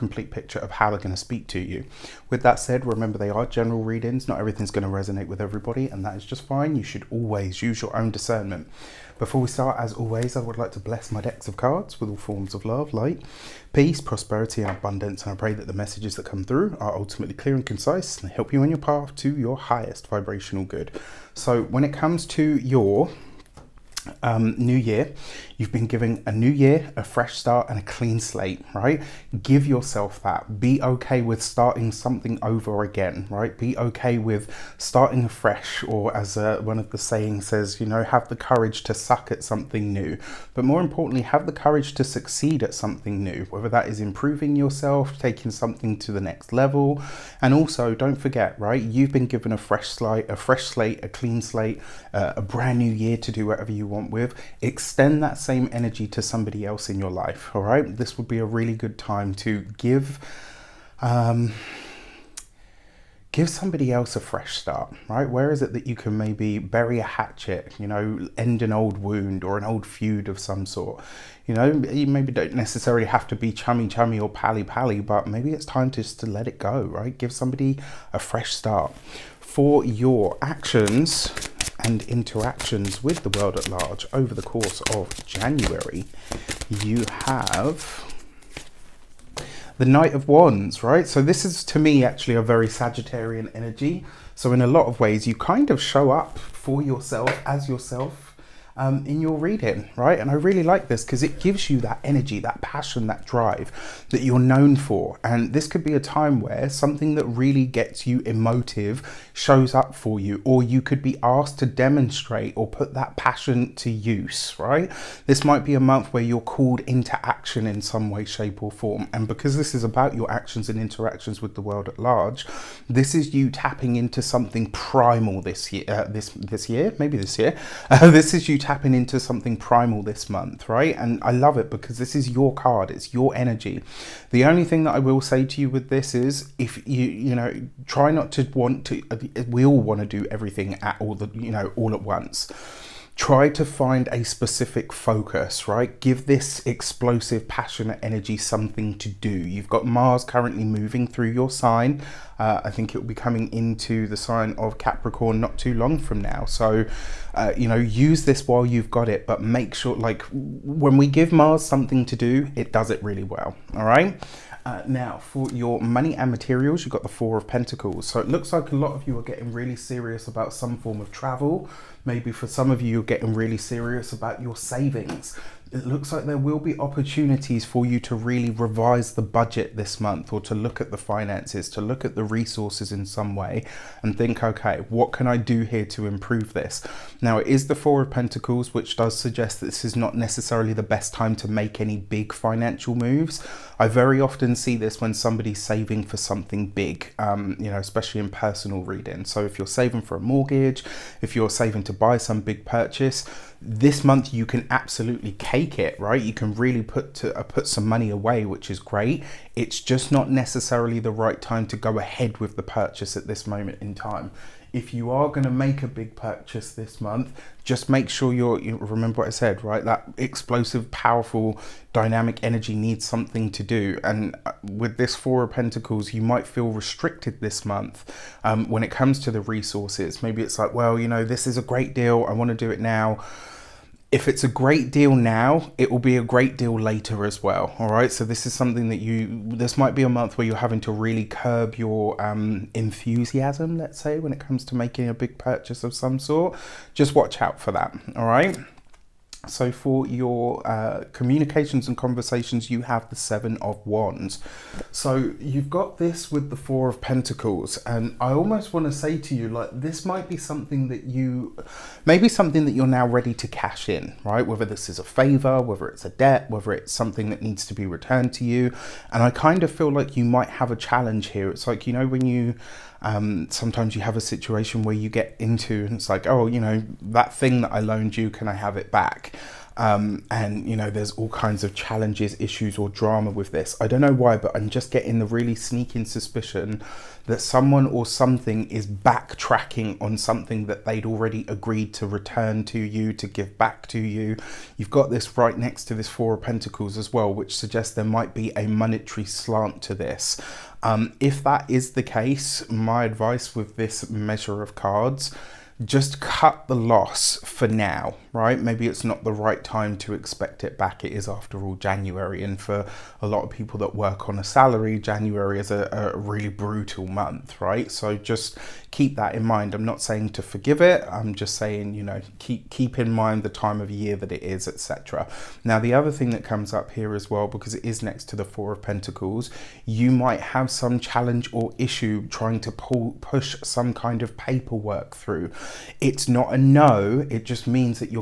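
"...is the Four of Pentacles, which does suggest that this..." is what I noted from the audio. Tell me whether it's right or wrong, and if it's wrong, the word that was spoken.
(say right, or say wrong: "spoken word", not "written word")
right.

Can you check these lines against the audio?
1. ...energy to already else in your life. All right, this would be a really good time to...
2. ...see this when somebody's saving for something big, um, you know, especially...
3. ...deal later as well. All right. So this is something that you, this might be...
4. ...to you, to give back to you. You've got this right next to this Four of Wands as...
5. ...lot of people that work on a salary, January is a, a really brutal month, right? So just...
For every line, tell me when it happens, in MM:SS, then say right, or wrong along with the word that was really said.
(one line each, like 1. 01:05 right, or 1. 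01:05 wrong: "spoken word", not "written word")
1. 00:55 wrong: "somebody", not "already"
2. 03:14 right
3. 03:56 right
4. 04:52 wrong: "Pentacles", not "Wands"
5. 05:13 right.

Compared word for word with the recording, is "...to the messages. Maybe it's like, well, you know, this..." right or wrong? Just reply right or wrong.
wrong.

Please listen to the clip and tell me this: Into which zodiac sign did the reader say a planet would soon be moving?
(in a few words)
Capricorn.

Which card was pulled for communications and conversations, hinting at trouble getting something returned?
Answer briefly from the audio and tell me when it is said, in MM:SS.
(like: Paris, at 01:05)
Seven of Wands, at 04:13.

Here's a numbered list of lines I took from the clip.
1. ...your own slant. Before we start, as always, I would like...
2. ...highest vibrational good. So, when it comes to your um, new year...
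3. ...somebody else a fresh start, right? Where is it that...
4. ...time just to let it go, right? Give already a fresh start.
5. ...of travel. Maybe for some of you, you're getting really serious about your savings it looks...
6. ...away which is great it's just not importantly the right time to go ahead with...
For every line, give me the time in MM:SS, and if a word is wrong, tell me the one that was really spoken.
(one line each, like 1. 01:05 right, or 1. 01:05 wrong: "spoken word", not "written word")
1. 00:07 wrong: "discernment", not "slant"
2. 00:19 right
3. 01:03 right
4. 01:15 wrong: "somebody", not "already"
5. 02:51 right
6. 03:28 wrong: "necessarily", not "importantly".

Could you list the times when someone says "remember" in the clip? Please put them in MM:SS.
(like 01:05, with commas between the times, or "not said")
00:02, 03:38.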